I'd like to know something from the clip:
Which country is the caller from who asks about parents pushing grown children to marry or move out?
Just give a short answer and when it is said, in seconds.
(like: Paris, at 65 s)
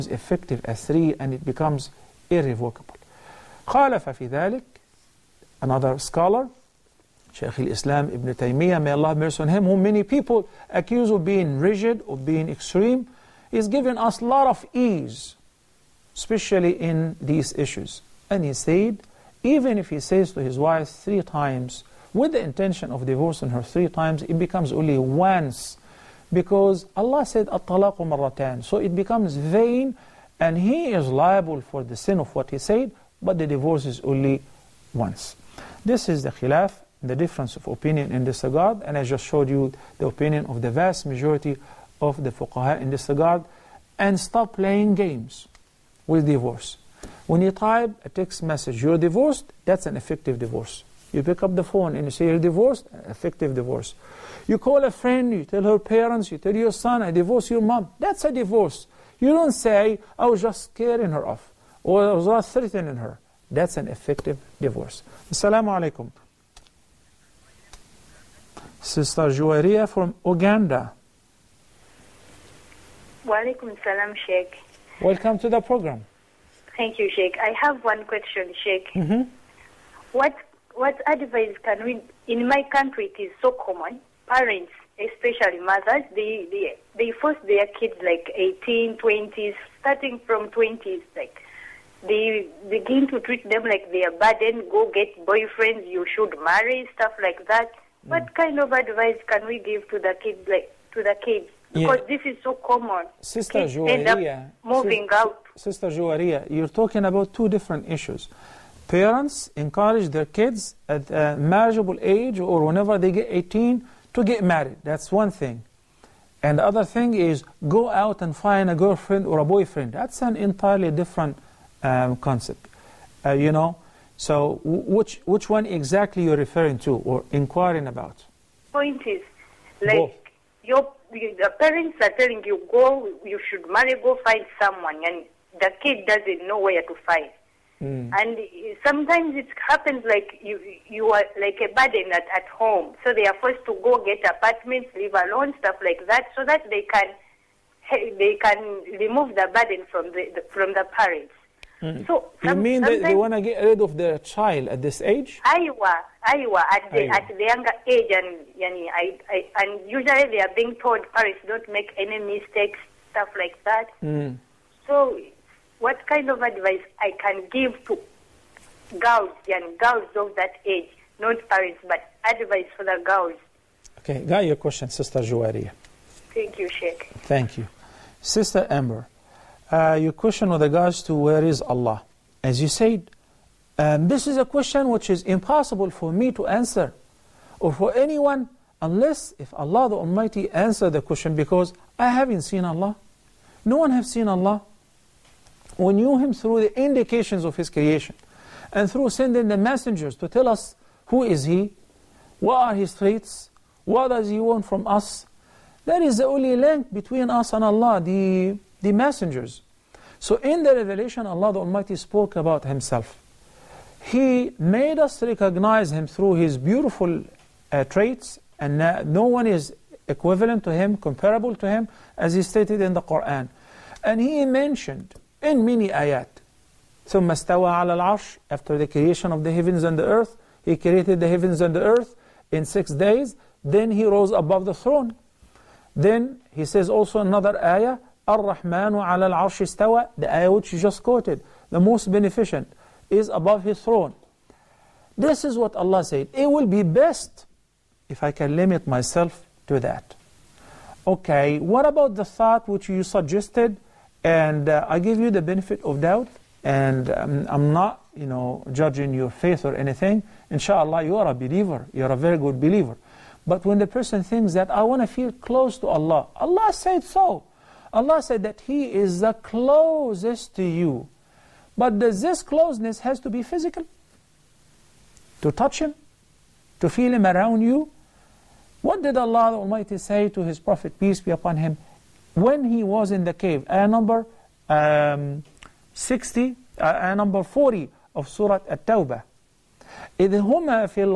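Uganda, at 70 s.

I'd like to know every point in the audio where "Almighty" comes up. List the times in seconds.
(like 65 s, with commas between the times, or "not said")
189 s, 211 s, 279 s.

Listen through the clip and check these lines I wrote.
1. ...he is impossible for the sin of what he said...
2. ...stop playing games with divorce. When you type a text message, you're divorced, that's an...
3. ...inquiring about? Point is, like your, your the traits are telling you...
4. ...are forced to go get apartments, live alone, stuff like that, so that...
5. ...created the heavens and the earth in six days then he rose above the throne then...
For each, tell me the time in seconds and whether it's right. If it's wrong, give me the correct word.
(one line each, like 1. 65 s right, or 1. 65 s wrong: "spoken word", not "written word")
1. 30 s wrong: "liable", not "impossible"
2. 44 s right
3. 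127 s wrong: "parents", not "traits"
4. 143 s right
5. 230 s right.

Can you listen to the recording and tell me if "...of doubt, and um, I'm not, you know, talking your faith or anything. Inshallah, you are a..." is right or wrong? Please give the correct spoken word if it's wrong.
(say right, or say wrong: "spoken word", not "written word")
wrong: "judging", not "talking".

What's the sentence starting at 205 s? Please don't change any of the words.
That is the only link between us and Allah, the, the messengers.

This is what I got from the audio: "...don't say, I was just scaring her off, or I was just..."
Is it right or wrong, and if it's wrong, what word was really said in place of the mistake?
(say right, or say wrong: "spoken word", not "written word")
right.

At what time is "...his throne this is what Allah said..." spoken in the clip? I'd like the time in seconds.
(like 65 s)
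243 s.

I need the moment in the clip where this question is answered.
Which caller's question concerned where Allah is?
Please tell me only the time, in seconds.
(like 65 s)
178 s.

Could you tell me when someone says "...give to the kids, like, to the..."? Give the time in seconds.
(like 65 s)
99 s.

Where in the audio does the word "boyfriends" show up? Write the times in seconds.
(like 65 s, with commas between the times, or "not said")
95 s, 119 s.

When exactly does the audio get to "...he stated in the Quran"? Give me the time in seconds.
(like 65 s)
222 s.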